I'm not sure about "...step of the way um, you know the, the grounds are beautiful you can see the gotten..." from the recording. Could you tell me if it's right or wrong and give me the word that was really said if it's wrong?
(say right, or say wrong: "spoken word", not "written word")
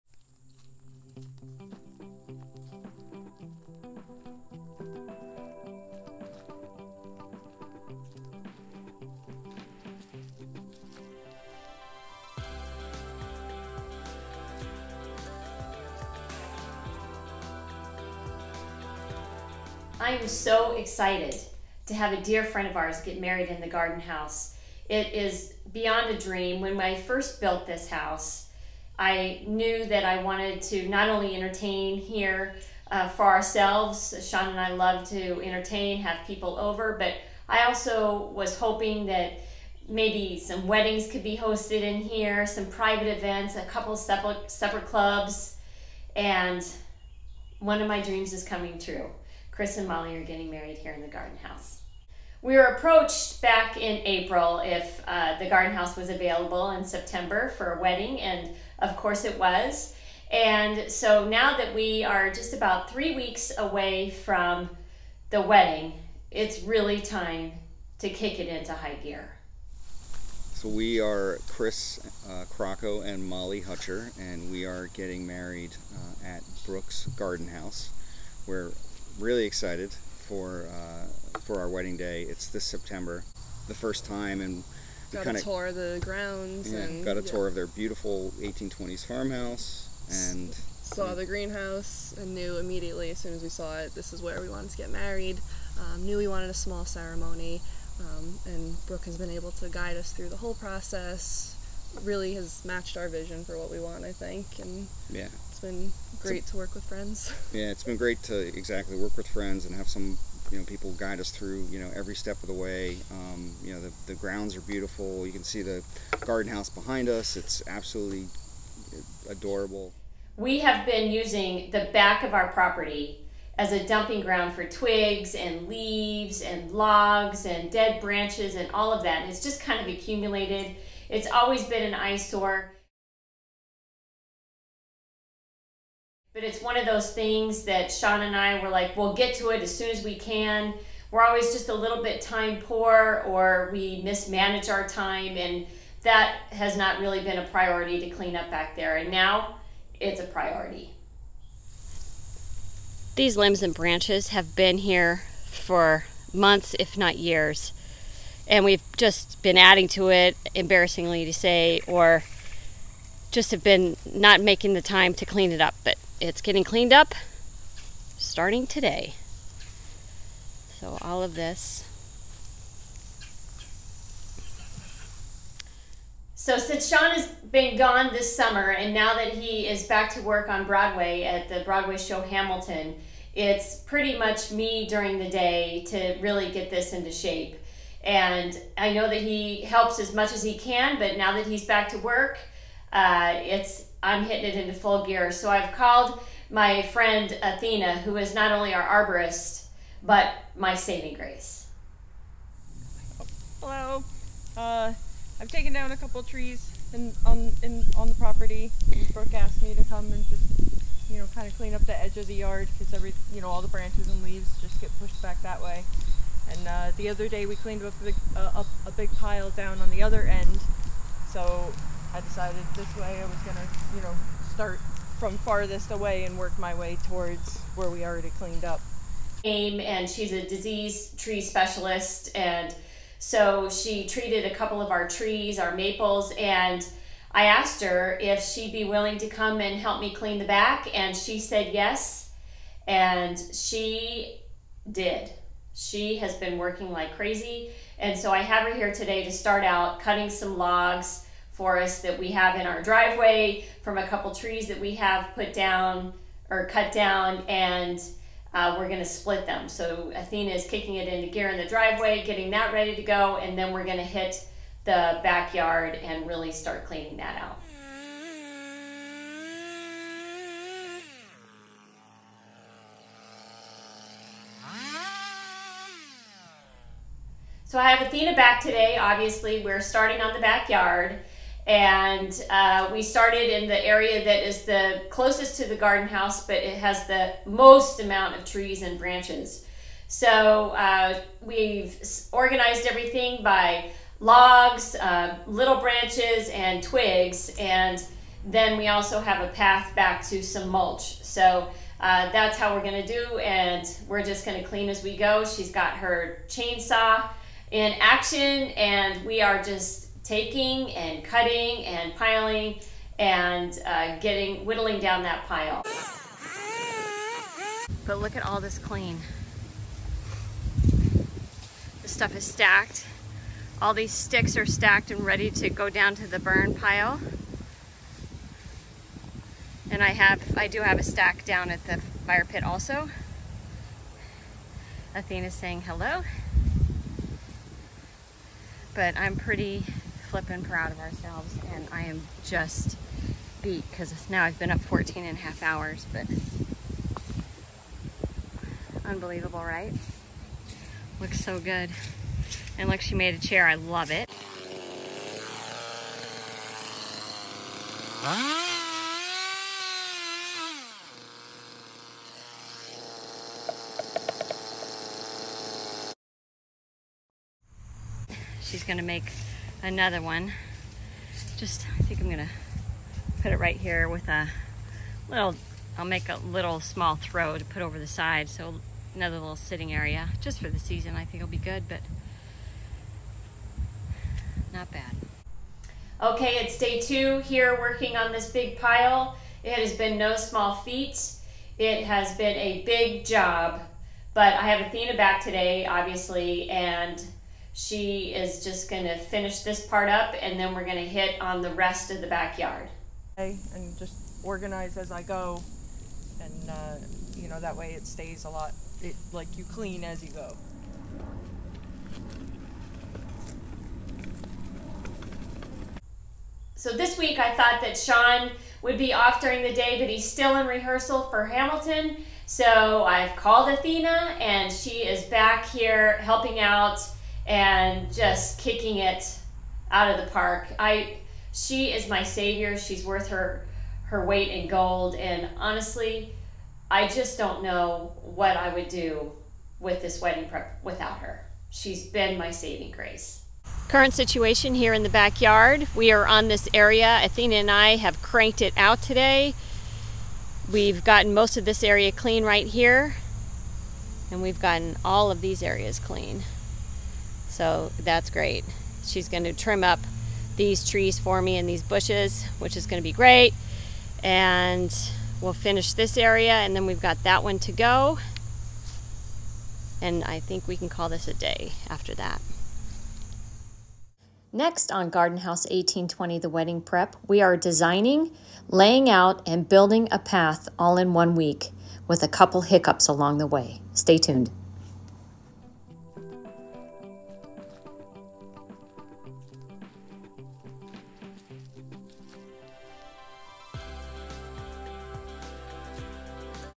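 wrong: "garden", not "gotten".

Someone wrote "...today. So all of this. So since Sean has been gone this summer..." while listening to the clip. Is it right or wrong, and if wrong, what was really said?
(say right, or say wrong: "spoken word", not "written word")
right.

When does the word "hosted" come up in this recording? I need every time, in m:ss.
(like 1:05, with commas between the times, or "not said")
0:41.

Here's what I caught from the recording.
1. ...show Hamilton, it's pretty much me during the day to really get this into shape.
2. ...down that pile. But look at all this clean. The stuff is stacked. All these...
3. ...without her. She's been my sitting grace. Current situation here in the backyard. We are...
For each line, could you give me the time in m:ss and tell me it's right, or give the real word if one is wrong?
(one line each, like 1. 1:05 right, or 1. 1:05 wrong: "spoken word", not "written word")
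1. 3:01 right
2. 5:14 right
3. 7:20 wrong: "saving", not "sitting".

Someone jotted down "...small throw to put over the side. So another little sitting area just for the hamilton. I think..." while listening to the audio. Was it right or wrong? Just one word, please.
wrong.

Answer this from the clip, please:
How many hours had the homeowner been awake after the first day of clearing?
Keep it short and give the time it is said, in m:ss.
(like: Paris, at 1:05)
14 and a half, at 5:44.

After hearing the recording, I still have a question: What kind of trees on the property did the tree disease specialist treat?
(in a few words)
maples.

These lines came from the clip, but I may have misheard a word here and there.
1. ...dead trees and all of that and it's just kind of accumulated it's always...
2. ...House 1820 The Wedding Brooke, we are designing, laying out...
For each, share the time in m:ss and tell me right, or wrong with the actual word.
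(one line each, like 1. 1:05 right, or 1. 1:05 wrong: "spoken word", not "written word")
1. 2:07 wrong: "branches", not "trees"
2. 7:55 wrong: "Prep", not "Brooke".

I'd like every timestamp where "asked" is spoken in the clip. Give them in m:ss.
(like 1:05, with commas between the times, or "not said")
3:29, 3:57.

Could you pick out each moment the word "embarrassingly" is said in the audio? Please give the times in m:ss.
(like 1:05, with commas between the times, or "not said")
2:40.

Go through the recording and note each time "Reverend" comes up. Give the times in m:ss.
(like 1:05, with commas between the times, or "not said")
not said.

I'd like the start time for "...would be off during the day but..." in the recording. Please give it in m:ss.
6:58.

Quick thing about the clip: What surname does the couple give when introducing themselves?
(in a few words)
Hutcher.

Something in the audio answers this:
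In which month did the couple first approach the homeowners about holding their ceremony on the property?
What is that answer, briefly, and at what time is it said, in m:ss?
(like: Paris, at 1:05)
April, at 0:53.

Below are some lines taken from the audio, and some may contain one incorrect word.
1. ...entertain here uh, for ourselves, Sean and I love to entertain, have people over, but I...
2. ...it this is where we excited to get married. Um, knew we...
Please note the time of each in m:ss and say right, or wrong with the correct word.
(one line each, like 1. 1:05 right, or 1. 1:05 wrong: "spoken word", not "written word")
1. 0:31 right
2. 1:33 wrong: "wanted", not "excited".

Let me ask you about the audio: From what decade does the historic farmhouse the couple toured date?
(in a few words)
1820s.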